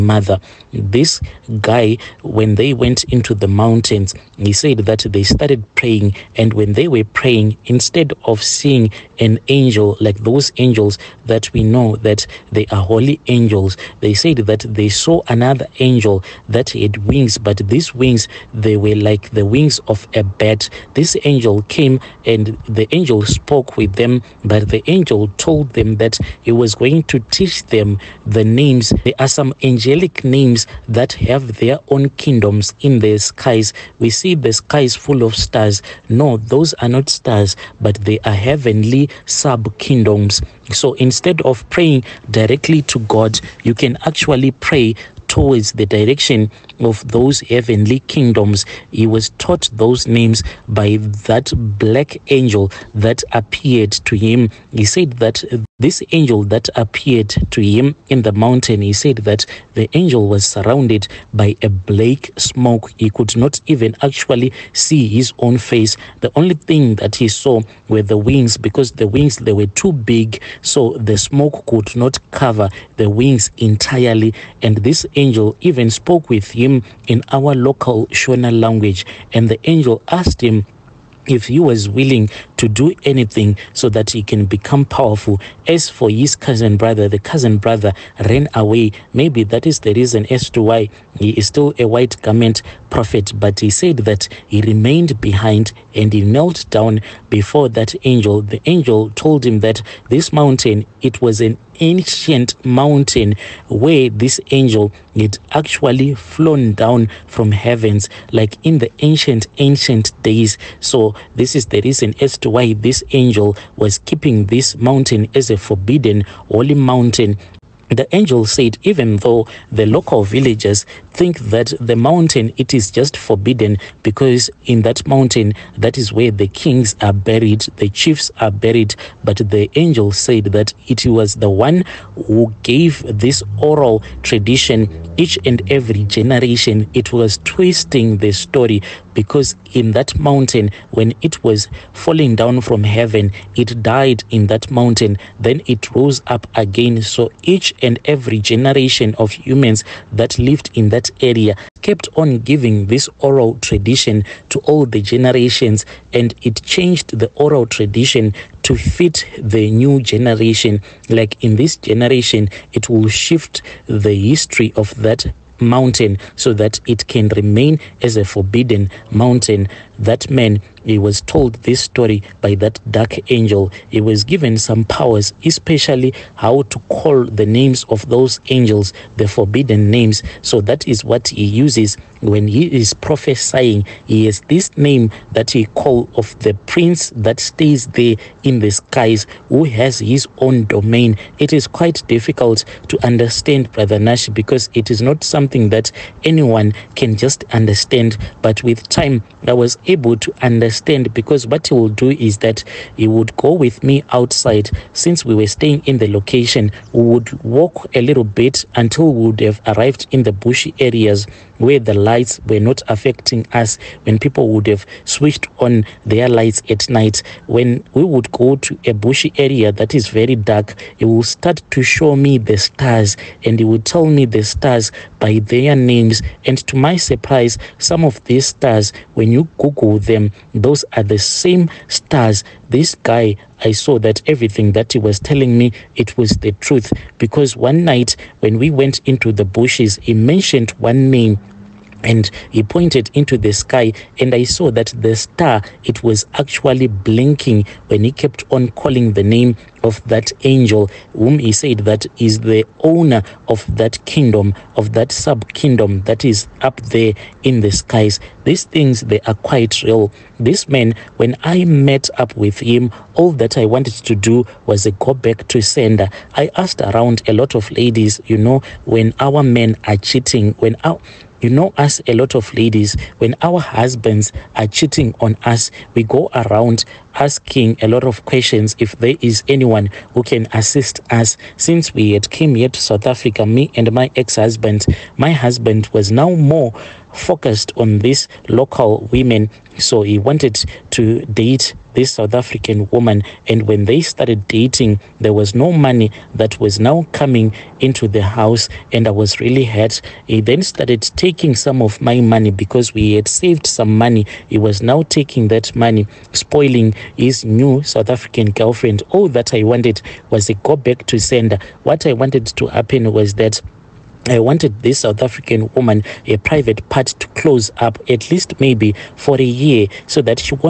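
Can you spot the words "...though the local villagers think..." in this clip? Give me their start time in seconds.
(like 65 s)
119 s.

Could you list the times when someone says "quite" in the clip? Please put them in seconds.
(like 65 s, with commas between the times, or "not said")
191 s, 259 s.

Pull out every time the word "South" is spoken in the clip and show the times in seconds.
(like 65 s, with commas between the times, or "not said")
282 s, 292 s, 307 s, 315 s.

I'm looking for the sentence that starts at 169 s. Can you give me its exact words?
That man, he was told this story by that dark angel.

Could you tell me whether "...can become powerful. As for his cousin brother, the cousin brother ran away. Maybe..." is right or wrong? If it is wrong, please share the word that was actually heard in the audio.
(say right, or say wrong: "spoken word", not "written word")
right.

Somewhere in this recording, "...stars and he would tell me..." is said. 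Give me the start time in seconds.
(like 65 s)
222 s.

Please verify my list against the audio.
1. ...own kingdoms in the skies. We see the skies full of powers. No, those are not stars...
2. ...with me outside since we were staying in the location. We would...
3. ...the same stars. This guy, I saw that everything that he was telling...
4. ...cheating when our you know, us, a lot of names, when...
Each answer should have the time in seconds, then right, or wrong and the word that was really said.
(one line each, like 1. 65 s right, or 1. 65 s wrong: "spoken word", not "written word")
1. 31 s wrong: "stars", not "powers"
2. 203 s right
3. 231 s right
4. 269 s wrong: "ladies", not "names".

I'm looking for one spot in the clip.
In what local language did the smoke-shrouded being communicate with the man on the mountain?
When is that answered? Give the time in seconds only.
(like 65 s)
78 s.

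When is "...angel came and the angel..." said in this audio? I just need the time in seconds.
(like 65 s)
21 s.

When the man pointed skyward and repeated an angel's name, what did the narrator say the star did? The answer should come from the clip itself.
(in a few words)
blinking.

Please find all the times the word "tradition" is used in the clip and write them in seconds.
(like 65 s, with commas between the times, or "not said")
134 s, 153 s, 157 s.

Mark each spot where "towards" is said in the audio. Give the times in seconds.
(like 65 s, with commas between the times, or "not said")
45 s.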